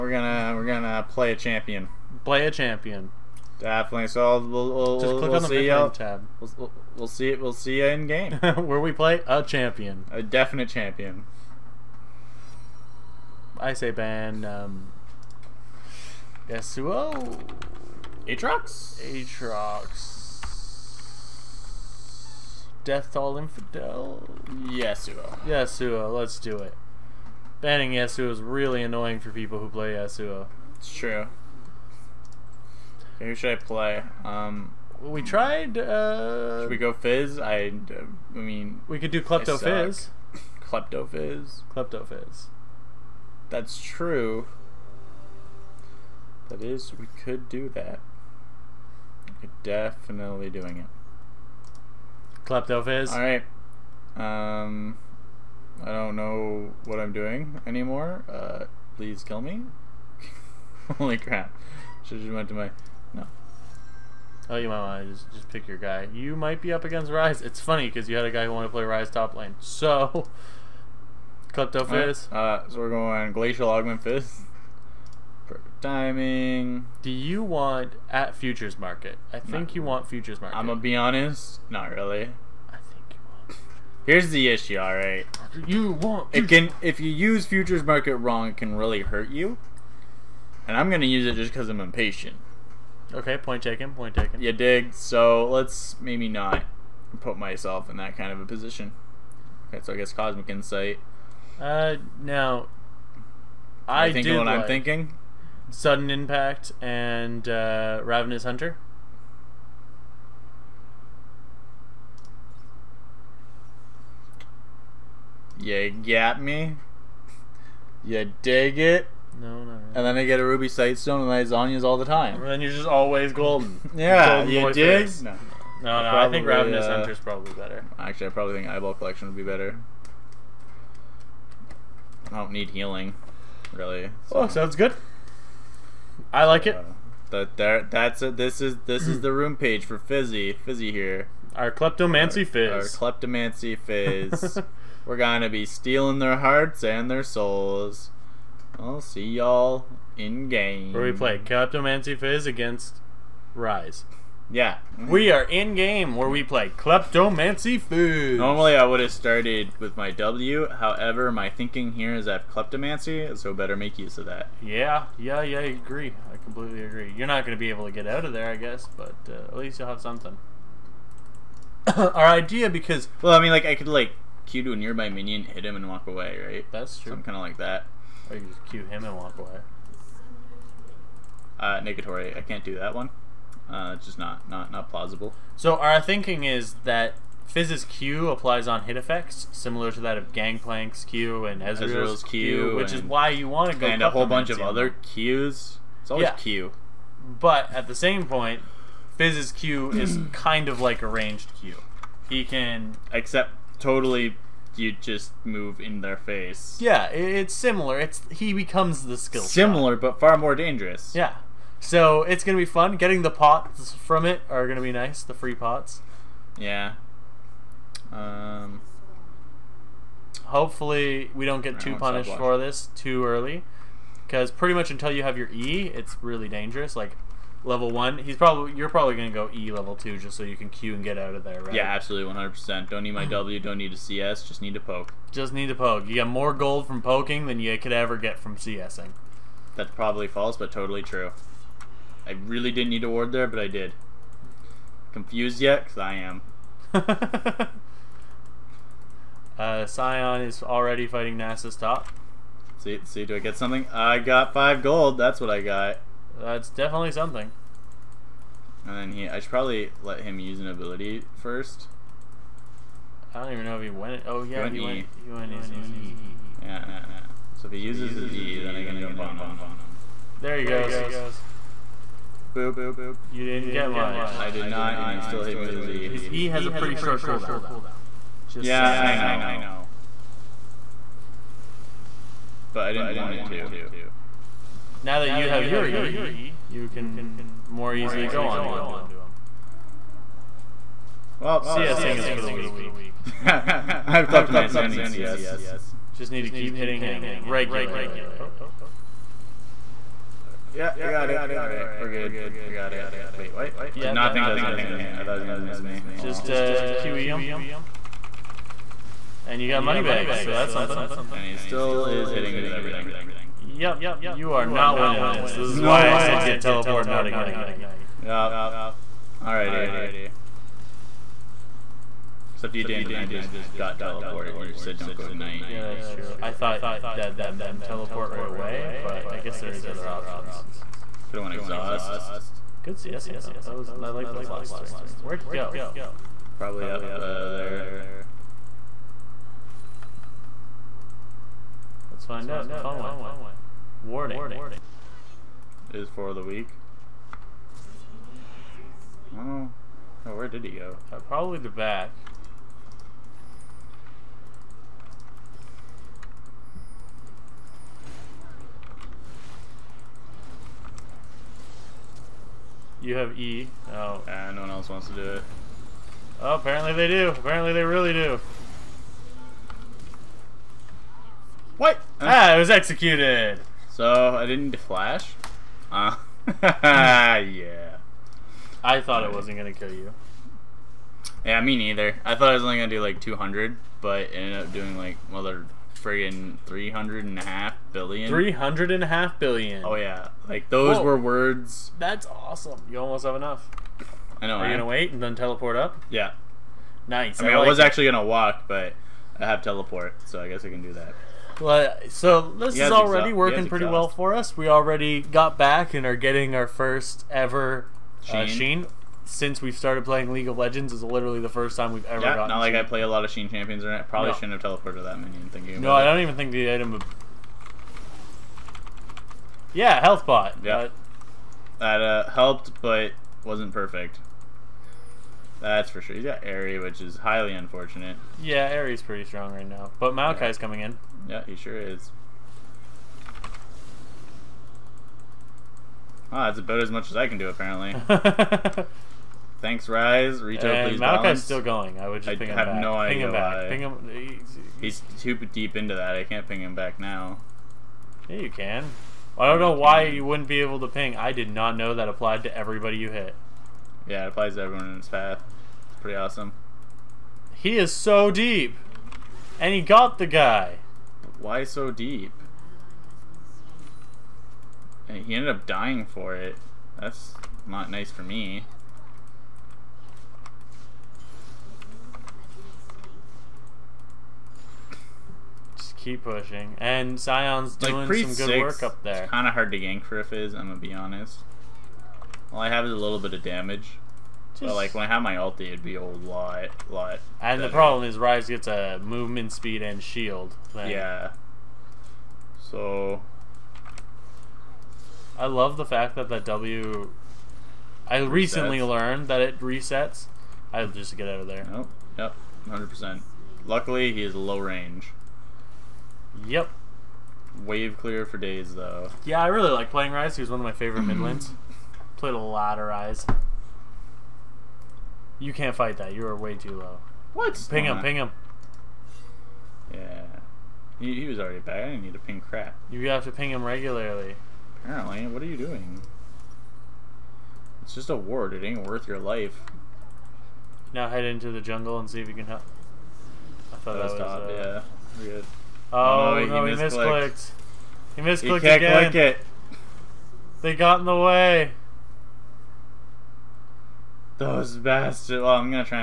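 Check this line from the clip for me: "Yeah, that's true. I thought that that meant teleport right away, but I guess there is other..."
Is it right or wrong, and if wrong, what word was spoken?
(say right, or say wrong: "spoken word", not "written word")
right.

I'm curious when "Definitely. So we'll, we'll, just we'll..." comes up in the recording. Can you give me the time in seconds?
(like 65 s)
3 s.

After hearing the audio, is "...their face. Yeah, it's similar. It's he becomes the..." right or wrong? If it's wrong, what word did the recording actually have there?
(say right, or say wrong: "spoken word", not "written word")
right.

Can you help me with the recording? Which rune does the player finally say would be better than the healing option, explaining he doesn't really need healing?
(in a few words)
Eyeball Collection.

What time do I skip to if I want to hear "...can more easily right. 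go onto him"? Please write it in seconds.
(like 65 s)
286 s.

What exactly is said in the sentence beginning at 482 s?
All I have is a little bit of damage.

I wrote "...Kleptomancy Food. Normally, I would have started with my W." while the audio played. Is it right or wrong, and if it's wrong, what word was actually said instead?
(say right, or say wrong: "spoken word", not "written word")
right.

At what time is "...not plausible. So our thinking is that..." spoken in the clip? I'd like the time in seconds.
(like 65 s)
184 s.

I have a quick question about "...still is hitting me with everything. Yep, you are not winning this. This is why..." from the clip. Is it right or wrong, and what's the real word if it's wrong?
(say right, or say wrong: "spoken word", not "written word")
right.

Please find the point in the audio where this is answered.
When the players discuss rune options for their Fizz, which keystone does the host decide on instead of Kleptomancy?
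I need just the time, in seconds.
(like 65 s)
73 s.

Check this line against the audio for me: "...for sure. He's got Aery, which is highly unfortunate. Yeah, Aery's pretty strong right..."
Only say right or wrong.
right.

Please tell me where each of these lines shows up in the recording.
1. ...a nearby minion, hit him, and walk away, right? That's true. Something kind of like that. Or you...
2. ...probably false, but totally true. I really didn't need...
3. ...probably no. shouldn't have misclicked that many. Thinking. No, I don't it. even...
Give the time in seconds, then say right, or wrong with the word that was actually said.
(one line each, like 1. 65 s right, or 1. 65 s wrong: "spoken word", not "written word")
1. 174 s right
2. 239 s right
3. 414 s wrong: "teleported", not "misclicked".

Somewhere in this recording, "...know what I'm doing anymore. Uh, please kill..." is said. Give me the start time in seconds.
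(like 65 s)
56 s.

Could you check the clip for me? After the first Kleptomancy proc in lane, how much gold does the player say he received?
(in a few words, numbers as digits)
5 gold.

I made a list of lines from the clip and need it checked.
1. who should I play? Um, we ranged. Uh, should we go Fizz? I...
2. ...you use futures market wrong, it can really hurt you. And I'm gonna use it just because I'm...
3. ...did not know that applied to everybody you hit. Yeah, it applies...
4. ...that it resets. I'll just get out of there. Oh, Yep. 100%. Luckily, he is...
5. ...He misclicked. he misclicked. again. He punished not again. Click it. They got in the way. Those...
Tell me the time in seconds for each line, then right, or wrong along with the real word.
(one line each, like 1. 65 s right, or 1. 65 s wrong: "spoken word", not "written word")
1. 33 s wrong: "tried", not "ranged"
2. 86 s right
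3. 451 s right
4. 499 s right
5. 536 s wrong: "misclicked", not "punished".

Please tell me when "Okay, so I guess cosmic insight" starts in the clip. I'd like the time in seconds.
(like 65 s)
99 s.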